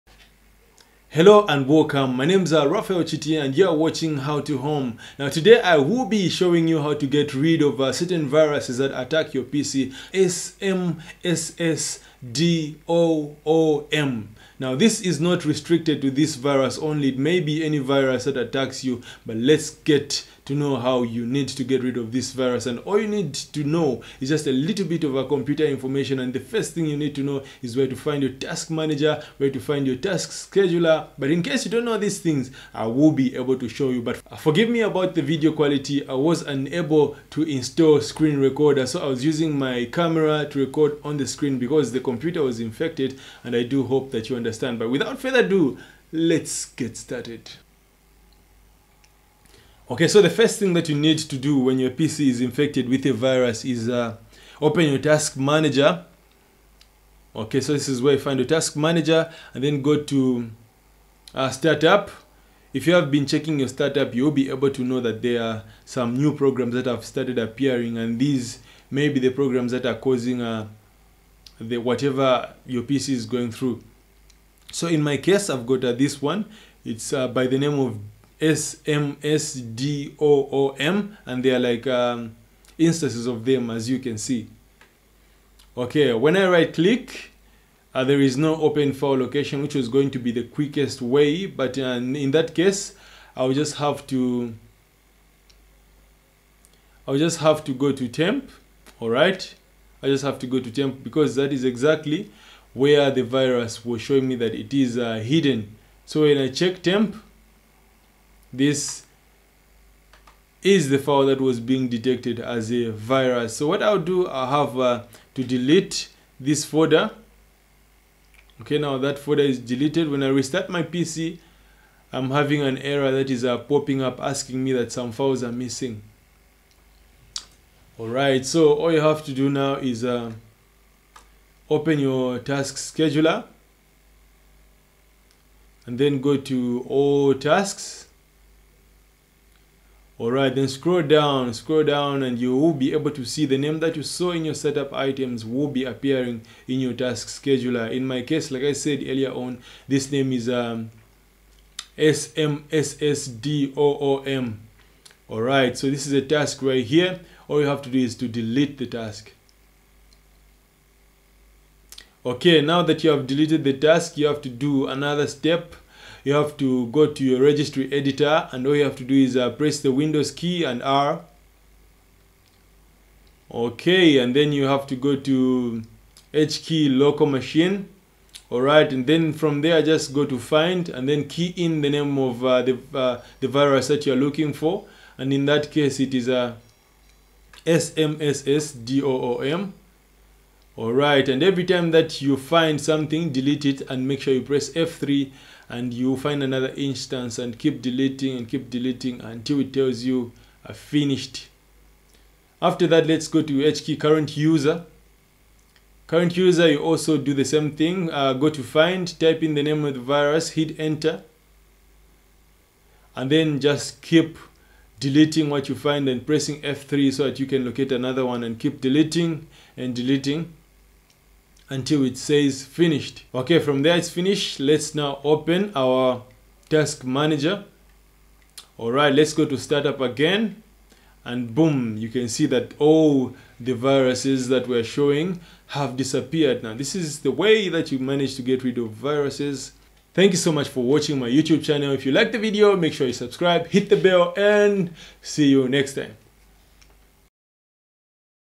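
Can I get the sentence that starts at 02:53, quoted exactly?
Okay, and then you have to go to H key local machine.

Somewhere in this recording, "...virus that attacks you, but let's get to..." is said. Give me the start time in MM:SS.
00:17.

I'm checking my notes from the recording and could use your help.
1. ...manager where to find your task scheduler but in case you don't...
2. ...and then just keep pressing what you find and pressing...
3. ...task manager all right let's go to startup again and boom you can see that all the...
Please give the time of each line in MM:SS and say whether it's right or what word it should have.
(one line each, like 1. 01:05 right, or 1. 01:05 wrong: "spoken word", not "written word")
1. 00:28 right
2. 03:33 wrong: "deleting", not "pressing"
3. 03:46 right.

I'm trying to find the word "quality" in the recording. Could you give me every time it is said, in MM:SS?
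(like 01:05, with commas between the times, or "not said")
00:35.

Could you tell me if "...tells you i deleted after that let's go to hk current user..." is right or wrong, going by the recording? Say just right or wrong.
wrong.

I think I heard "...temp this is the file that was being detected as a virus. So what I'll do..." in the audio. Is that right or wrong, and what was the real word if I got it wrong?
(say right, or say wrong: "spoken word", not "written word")
right.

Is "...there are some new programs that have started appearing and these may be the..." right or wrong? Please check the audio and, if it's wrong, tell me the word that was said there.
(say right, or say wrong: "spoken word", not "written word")
right.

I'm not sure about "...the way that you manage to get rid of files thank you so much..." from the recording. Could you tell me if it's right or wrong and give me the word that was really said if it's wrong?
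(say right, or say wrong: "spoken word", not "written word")
wrong: "viruses", not "files".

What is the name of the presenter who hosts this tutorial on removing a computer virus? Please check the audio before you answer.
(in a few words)
Rafael Chiti.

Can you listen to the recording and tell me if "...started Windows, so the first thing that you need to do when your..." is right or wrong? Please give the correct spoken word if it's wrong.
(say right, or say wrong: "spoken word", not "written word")
wrong: "Okay", not "Windows".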